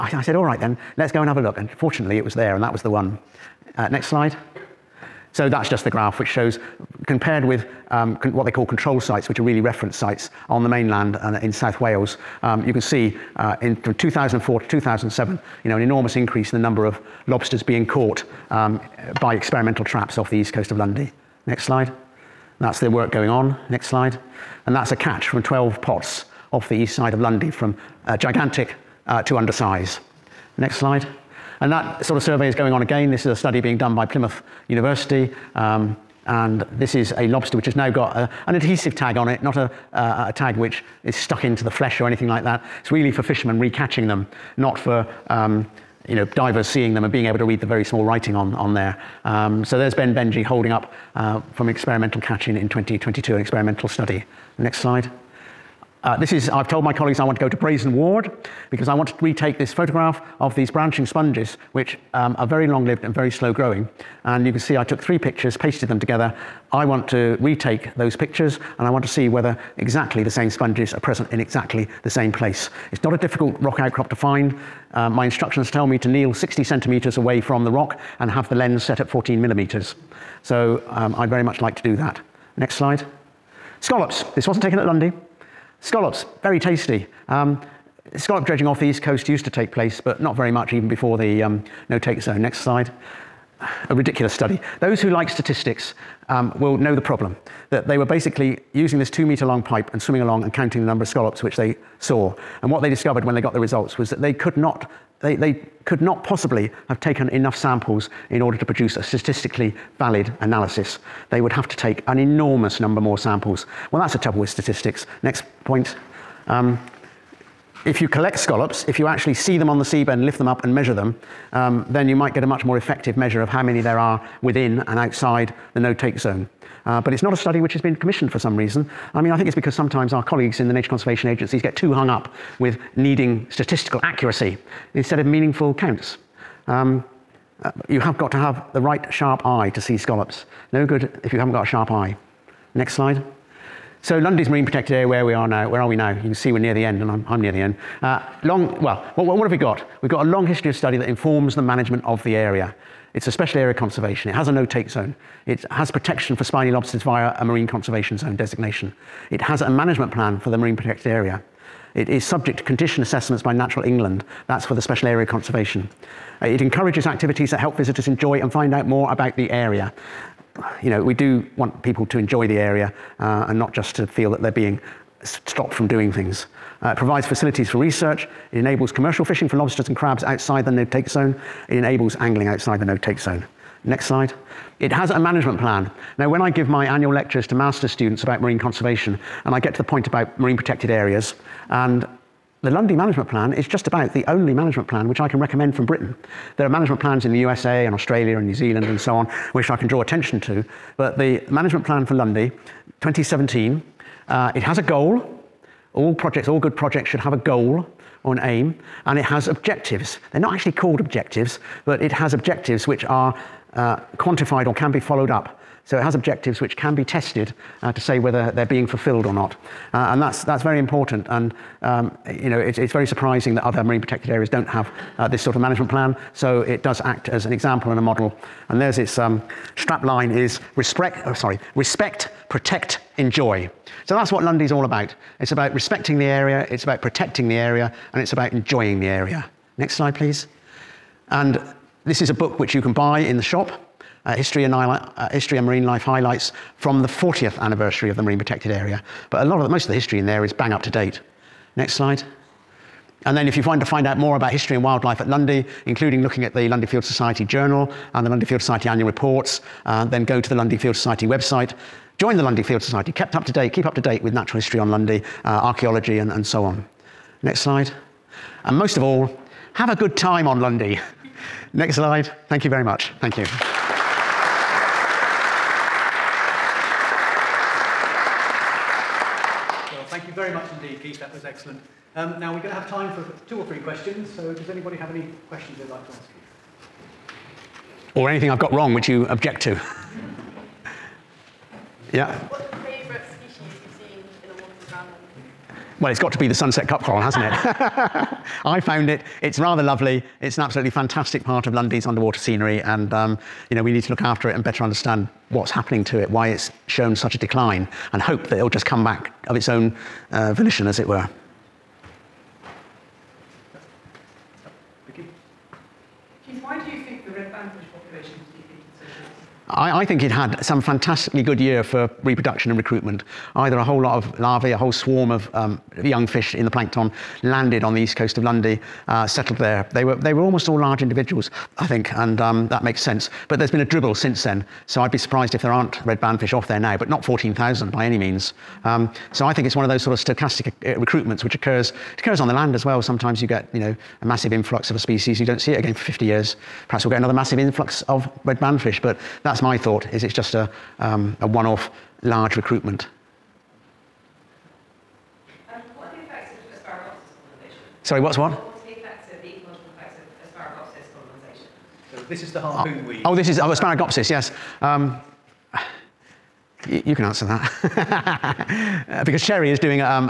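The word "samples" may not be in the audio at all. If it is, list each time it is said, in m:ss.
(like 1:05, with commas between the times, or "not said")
1:47, 1:53.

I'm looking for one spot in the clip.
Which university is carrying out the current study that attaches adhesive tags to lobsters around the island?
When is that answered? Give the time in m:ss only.
0:34.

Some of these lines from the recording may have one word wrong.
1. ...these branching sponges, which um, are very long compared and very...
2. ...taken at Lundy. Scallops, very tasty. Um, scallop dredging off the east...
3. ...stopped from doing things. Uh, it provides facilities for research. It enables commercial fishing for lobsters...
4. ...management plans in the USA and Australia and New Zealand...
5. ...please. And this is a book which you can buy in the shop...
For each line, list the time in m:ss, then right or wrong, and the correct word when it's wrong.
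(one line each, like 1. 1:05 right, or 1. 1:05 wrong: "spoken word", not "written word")
1. 1:00 wrong: "lived", not "compared"
2. 1:24 right
3. 2:55 right
4. 3:16 right
5. 4:00 right.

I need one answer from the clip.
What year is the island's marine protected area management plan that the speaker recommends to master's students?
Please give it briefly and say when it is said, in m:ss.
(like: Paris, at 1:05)
2017, at 3:22.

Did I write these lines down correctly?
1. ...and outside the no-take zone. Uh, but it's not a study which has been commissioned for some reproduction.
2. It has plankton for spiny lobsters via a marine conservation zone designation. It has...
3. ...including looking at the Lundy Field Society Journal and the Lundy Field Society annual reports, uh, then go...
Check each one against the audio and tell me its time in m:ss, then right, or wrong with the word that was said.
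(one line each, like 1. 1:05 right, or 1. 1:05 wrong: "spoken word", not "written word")
1. 2:04 wrong: "reason", not "reproduction"
2. 2:35 wrong: "protection", not "plankton"
3. 4:15 right.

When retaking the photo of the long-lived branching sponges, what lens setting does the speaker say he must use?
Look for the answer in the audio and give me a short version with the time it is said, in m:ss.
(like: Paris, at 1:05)
14 millimeters, at 1:19.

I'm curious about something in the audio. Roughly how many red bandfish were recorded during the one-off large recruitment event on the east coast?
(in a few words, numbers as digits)
14,000.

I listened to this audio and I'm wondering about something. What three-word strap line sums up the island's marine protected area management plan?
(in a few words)
respect, protect, enjoy.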